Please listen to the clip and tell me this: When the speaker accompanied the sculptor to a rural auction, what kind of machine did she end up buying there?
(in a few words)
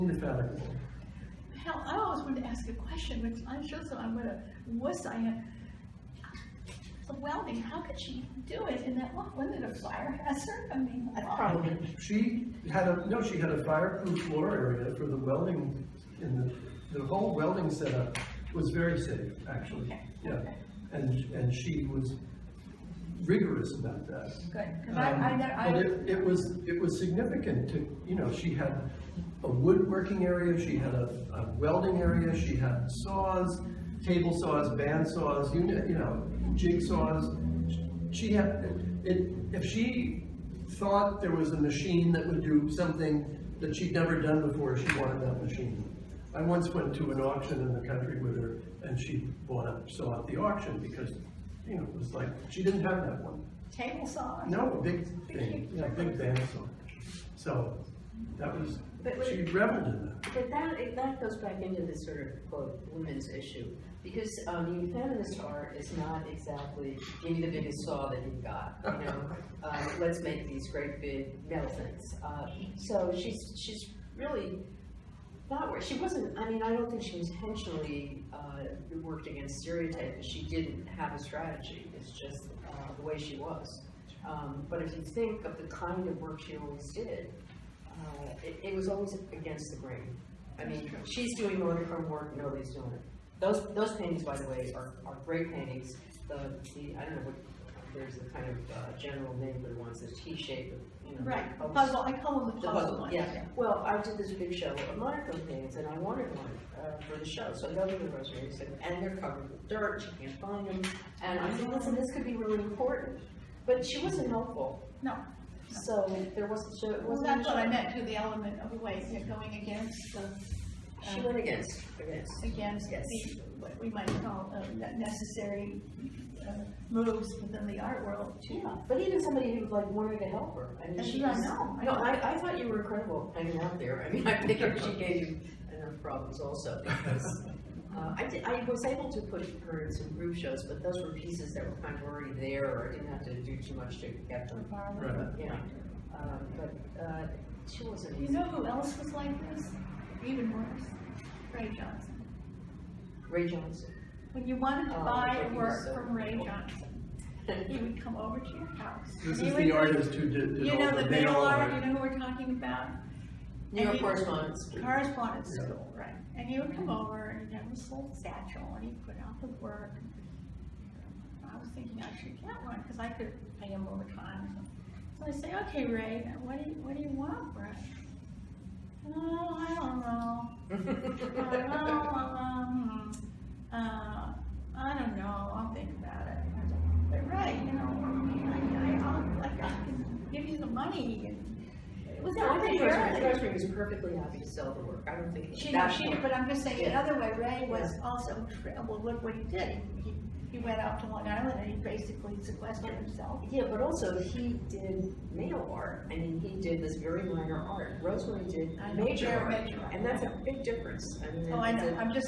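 bandsaw.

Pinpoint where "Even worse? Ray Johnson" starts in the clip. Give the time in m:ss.
2:30.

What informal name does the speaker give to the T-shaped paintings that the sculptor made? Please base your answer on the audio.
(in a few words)
the puzzle ones.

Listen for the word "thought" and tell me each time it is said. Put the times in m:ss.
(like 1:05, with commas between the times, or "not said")
0:40, 2:12.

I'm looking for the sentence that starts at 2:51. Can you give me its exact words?
I was thinking I should get one because I could pay him time.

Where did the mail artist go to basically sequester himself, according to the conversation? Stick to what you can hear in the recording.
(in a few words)
Long Island.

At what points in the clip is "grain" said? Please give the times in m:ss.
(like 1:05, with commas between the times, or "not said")
1:29.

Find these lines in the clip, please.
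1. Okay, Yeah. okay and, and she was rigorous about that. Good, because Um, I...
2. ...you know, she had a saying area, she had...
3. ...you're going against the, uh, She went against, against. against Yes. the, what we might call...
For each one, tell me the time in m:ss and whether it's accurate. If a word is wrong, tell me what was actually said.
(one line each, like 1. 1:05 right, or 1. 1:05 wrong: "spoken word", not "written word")
1. 0:19 right
2. 0:28 wrong: "woodworking", not "saying"
3. 1:59 right.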